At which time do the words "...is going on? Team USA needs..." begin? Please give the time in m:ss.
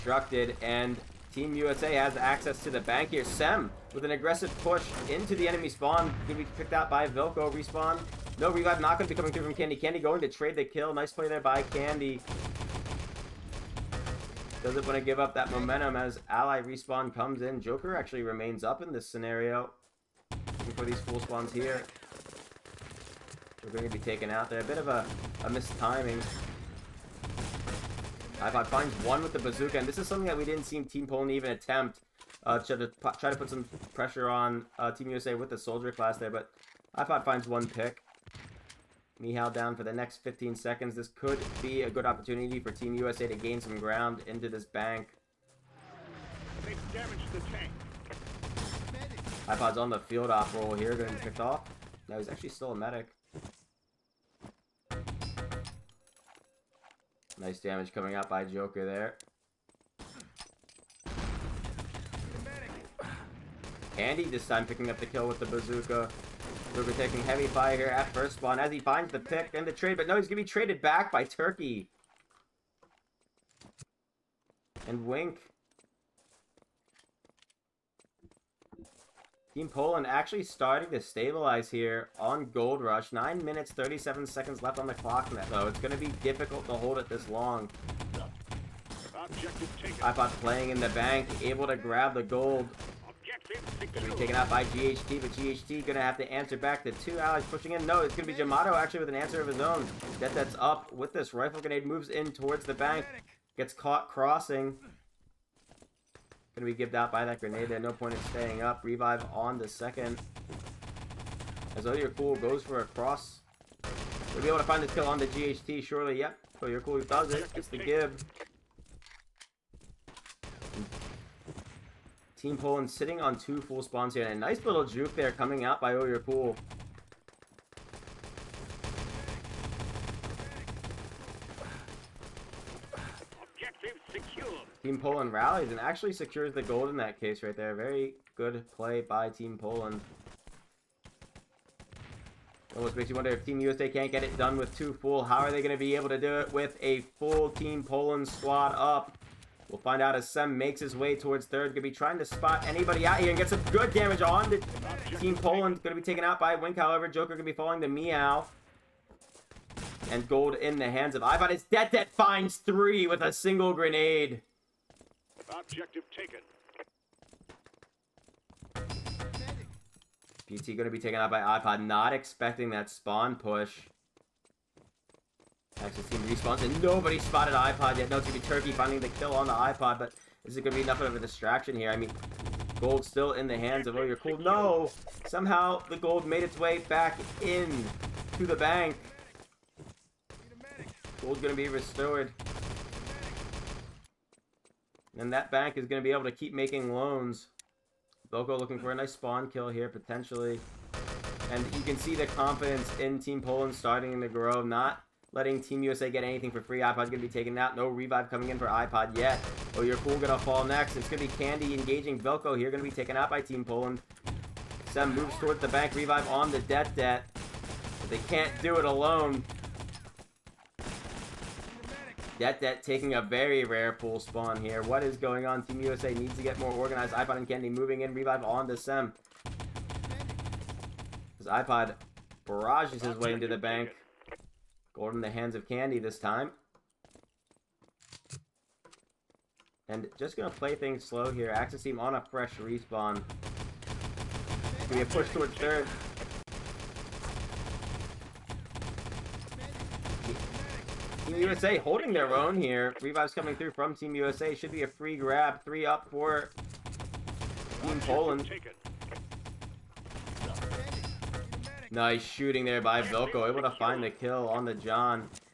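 3:45.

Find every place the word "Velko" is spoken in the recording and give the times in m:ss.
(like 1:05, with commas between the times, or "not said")
3:32, 4:23.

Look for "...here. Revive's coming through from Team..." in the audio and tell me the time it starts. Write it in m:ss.
4:12.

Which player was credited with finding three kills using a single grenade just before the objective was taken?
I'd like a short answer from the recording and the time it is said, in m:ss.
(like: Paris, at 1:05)
Dead Dead, at 2:41.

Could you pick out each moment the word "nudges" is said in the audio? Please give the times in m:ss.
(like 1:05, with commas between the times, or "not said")
not said.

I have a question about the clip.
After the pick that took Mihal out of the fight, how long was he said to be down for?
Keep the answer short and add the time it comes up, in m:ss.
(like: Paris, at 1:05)
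15 seconds, at 0:40.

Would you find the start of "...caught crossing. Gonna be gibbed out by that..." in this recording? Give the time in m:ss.
1:43.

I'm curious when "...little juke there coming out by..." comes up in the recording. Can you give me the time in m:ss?
2:04.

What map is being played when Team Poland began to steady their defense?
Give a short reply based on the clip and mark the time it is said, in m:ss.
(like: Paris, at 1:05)
Gold Rush, at 1:22.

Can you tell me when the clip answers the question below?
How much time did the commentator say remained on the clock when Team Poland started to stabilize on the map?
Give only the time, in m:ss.
1:23.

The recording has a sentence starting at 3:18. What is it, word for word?
Boko looking for a nice spawn kill here, potentially.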